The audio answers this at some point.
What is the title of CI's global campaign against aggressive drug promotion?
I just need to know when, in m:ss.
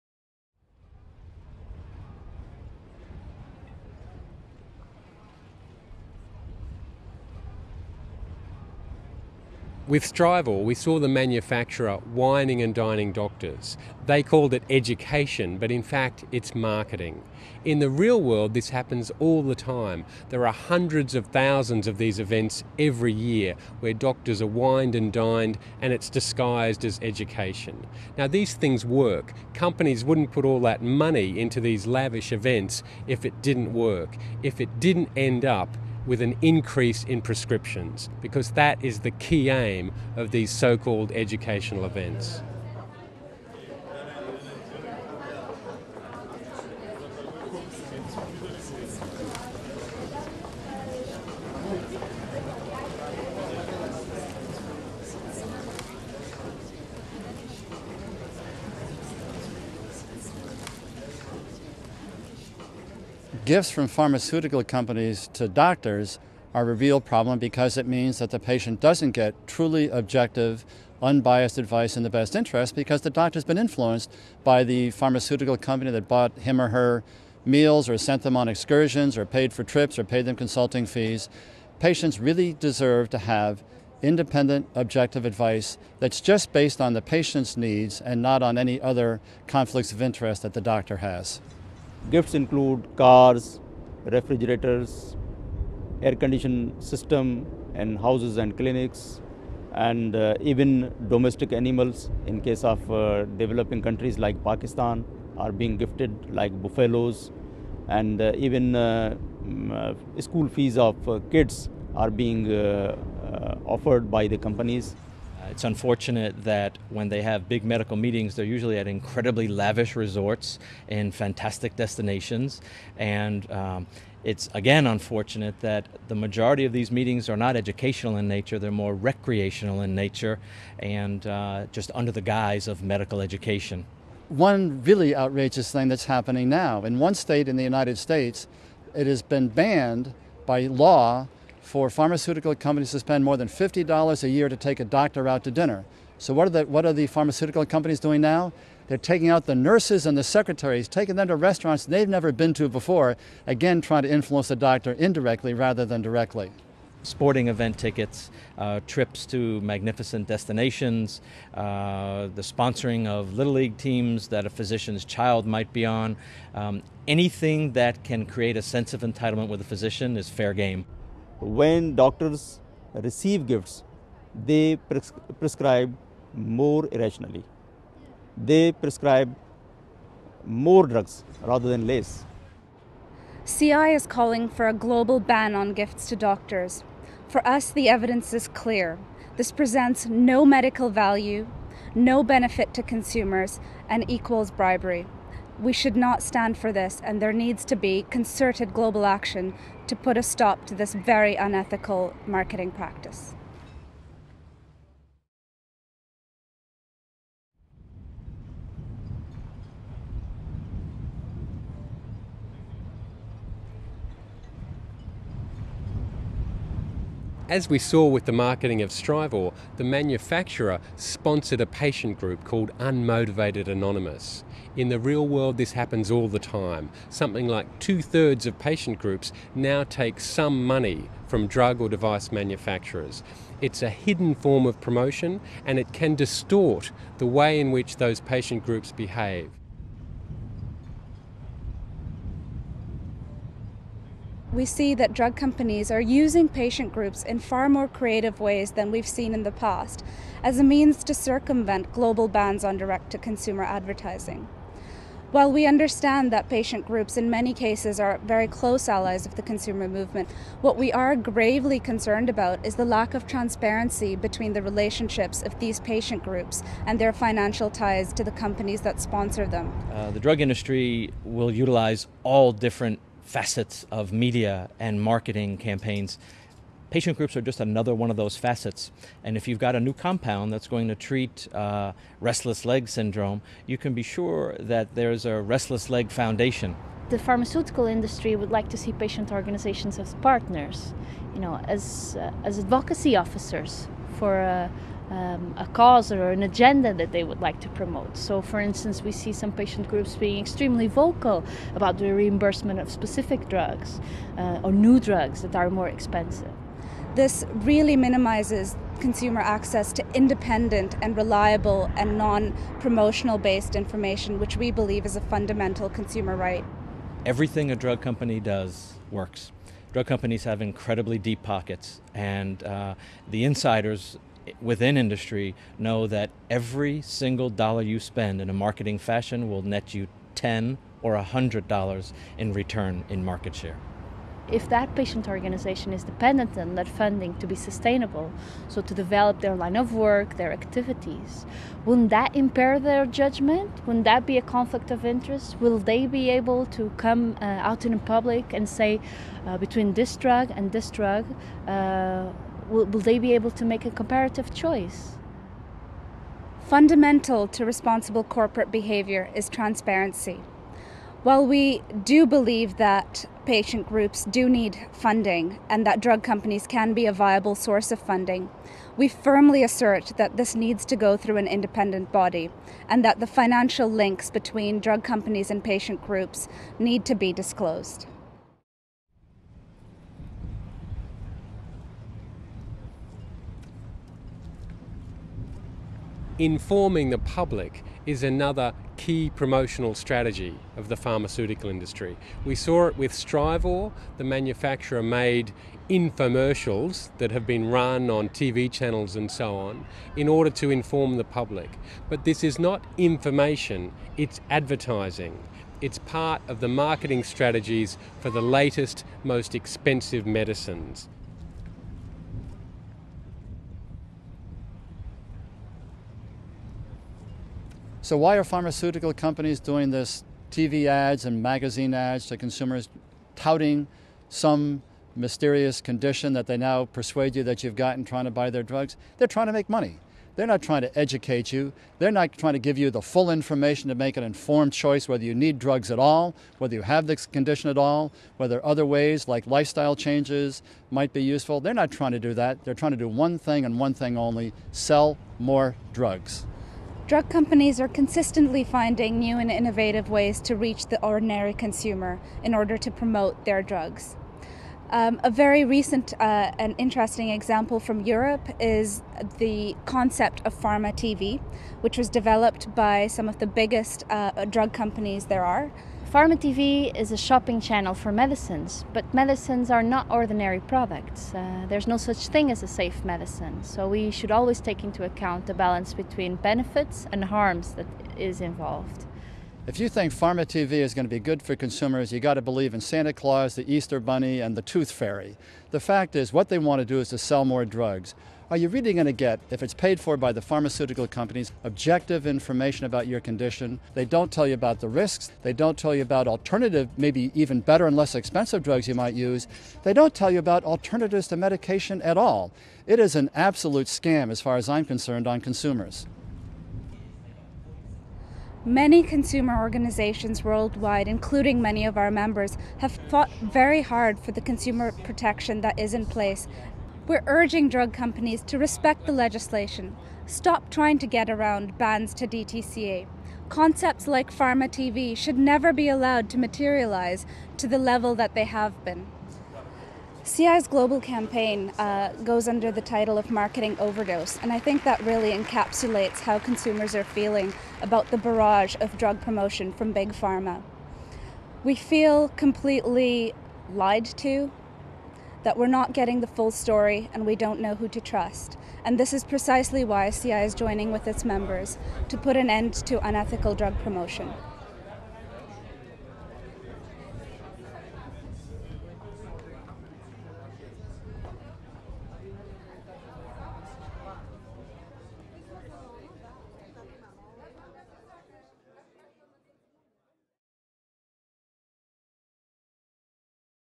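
8:53.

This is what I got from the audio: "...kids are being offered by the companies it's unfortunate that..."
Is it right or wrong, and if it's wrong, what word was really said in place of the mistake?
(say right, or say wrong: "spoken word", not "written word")
right.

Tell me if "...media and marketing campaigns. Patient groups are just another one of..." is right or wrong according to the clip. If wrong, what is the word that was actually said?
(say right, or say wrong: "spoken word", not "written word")
right.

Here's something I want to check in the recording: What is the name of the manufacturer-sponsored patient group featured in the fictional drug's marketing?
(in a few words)
Unmotivated Anonymous.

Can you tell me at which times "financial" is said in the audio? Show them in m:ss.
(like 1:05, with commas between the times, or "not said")
4:27, 6:13.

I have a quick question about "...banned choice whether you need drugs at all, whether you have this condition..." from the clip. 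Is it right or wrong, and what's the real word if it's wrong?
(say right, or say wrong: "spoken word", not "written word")
wrong: "informed", not "banned".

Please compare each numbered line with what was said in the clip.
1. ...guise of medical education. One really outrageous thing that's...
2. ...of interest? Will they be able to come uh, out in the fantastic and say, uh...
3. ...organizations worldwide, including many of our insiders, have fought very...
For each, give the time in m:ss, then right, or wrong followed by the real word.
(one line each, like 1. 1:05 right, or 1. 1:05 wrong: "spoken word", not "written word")
1. 2:12 right
2. 5:44 wrong: "public", not "fantastic"
3. 8:29 wrong: "members", not "insiders".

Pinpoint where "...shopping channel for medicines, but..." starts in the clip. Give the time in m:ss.
7:47.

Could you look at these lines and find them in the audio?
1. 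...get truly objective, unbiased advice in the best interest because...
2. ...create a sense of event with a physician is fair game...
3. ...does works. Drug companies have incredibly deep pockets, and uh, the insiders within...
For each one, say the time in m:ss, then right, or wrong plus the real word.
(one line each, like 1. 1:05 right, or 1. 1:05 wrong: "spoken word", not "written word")
1. 1:09 right
2. 2:48 wrong: "entitlement", not "event"
3. 5:18 right.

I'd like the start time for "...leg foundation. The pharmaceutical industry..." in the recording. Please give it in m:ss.
4:45.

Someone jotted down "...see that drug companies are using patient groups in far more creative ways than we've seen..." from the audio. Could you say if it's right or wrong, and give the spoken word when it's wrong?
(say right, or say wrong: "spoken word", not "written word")
right.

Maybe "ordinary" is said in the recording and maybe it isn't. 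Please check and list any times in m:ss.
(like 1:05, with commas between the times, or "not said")
7:31, 7:50.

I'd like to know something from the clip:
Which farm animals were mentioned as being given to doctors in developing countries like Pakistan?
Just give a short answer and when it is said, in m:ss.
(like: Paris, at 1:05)
buffaloes, at 1:46.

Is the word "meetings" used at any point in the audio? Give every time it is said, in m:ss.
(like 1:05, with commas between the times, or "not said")
1:57, 2:06.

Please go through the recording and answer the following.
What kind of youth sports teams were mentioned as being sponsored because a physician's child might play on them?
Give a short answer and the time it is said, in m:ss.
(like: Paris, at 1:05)
little league teams, at 2:43.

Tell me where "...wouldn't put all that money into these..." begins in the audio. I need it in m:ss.
0:30.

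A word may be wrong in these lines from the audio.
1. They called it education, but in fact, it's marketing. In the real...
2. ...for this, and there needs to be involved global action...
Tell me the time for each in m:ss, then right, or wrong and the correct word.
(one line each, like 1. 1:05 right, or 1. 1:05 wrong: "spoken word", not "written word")
1. 0:14 right
2. 3:16 wrong: "concerted", not "involved".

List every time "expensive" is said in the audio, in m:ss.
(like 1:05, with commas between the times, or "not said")
5:05, 6:49, 8:18.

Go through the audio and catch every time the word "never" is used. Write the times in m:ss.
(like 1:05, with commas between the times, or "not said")
2:32, 8:45.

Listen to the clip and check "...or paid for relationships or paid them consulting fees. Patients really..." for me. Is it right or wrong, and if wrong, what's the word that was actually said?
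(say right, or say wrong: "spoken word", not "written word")
wrong: "trips", not "relationships".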